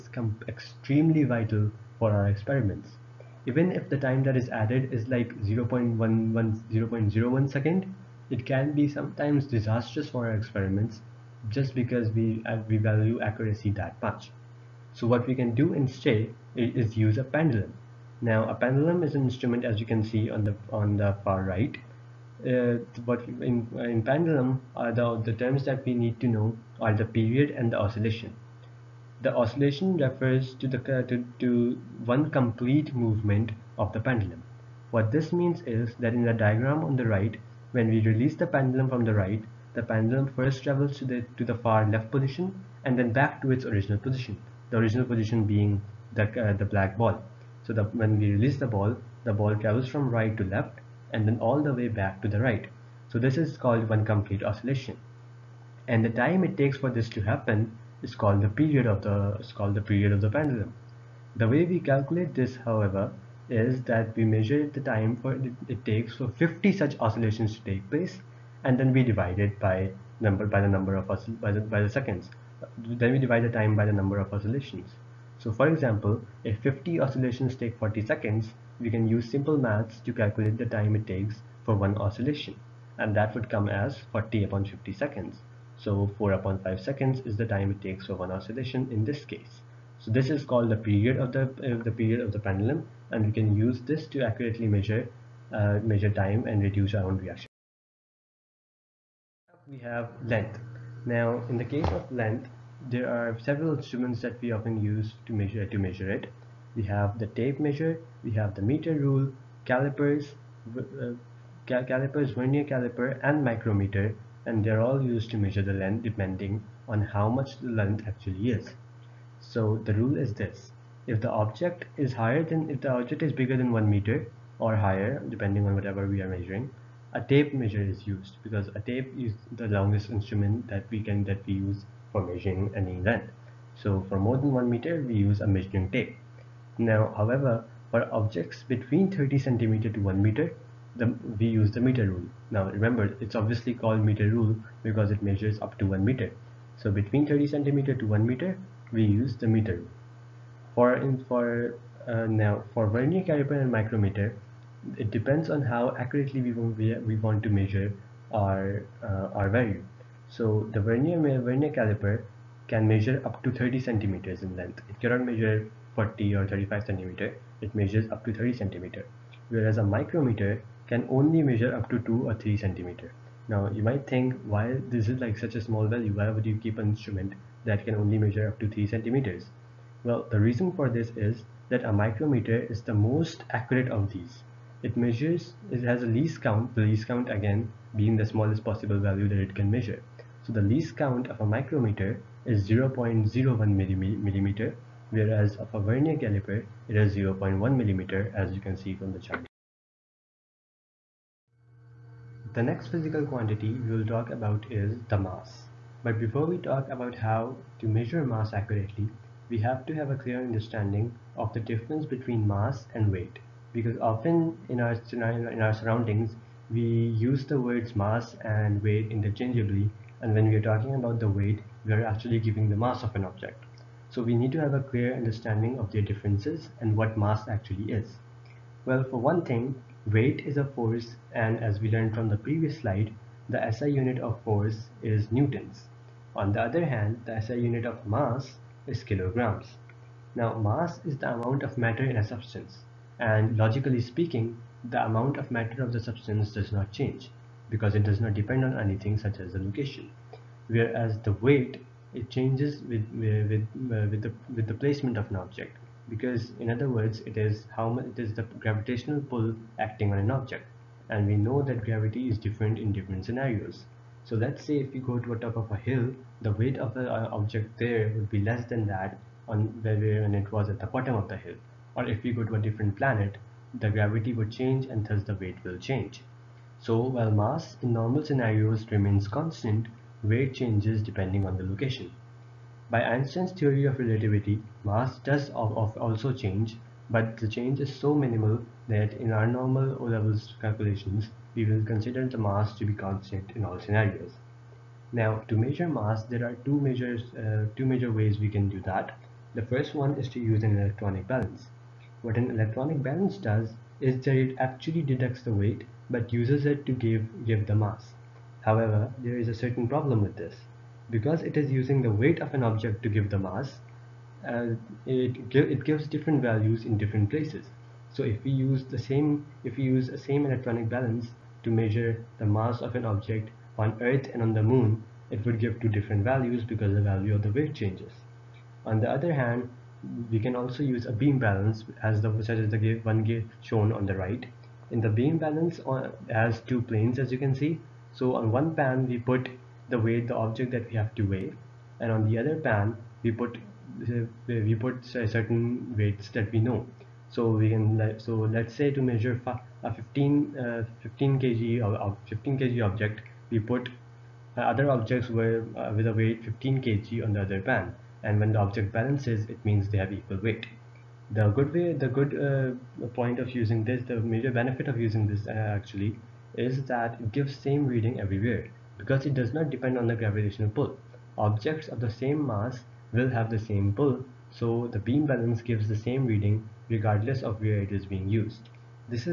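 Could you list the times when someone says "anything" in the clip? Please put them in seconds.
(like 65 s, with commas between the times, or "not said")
248 s.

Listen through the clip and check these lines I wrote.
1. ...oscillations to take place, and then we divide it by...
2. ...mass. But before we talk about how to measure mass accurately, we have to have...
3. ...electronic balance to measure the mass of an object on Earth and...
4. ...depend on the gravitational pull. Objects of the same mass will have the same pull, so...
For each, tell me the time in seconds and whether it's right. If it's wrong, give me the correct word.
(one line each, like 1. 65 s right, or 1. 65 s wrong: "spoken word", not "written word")
1. 66 s right
2. 205 s right
3. 320 s right
4. 369 s right.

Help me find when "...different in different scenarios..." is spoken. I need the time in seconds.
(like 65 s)
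262 s.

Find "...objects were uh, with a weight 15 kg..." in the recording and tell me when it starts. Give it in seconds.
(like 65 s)
354 s.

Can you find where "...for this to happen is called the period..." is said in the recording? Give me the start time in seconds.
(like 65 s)
56 s.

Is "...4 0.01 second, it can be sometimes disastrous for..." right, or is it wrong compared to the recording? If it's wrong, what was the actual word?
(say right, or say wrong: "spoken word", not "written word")
wrong: "0", not "4".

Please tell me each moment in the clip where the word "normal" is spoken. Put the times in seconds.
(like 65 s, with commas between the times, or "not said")
278 s, 289 s.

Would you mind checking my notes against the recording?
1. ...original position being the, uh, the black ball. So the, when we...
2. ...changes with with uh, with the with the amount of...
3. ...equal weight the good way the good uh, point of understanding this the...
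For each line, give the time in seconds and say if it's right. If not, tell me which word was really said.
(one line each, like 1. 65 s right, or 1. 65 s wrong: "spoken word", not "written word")
1. 44 s right
2. 252 s wrong: "placement", not "amount"
3. 360 s wrong: "using", not "understanding".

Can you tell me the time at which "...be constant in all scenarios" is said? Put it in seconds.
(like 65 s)
292 s.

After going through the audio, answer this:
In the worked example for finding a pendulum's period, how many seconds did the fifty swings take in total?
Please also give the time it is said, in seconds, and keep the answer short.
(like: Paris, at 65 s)
40, at 77 s.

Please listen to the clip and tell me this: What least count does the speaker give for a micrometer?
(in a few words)
0.01 millimeter.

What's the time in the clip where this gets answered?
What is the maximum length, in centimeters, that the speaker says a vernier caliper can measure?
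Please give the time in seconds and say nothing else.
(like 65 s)
163 s.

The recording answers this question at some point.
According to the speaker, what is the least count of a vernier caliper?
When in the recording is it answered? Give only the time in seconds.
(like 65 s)
197 s.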